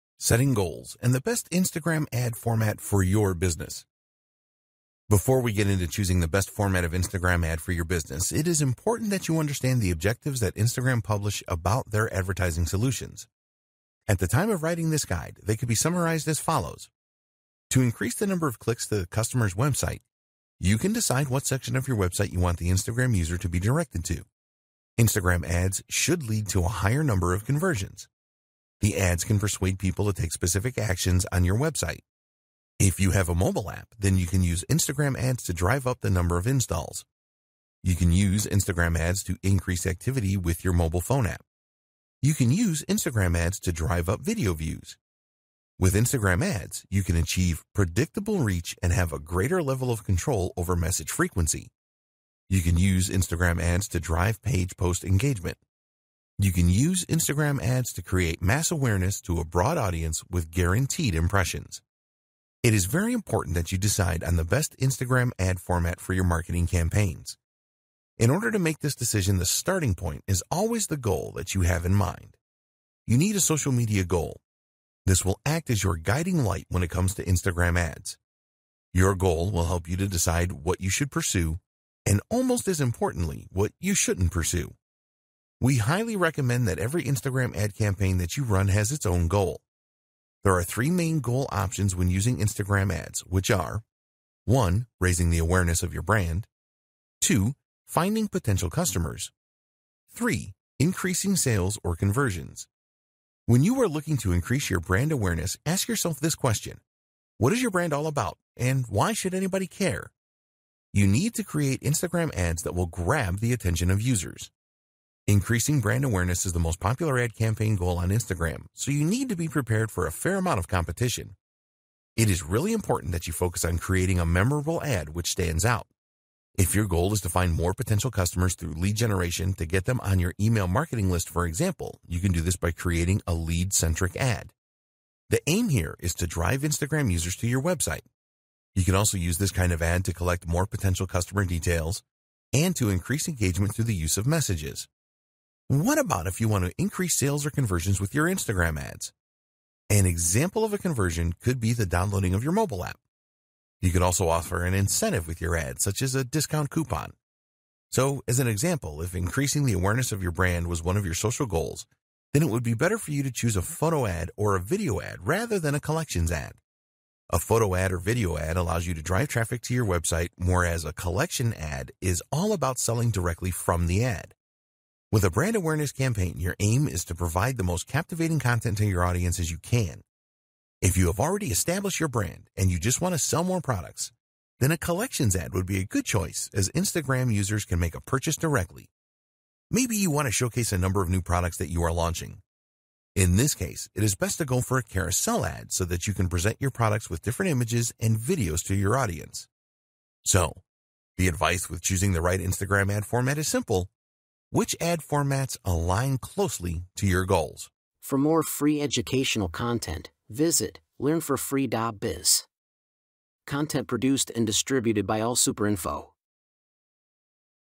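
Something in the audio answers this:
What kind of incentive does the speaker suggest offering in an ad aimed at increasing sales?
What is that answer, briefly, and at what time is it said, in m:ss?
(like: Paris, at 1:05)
A discount coupon, at 2:36.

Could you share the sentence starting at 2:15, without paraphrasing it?
The aim here is to drive Instagram users to your website.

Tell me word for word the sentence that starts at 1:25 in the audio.
We highly recommend that every Instagram ad campaign that you run has its own goal.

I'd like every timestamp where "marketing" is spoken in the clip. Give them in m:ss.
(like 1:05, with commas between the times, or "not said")
1:06, 2:10.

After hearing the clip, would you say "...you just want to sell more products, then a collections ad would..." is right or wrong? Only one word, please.
right.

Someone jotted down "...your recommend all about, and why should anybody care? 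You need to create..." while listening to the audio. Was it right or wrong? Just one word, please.
wrong.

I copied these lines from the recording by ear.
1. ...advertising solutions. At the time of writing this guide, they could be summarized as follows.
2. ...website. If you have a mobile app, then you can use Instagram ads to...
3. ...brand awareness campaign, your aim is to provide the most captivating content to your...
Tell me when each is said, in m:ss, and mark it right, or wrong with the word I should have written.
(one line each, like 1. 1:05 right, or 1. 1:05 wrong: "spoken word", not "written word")
1. 0:12 right
2. 0:31 right
3. 2:55 right.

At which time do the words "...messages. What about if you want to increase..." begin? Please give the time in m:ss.
2:24.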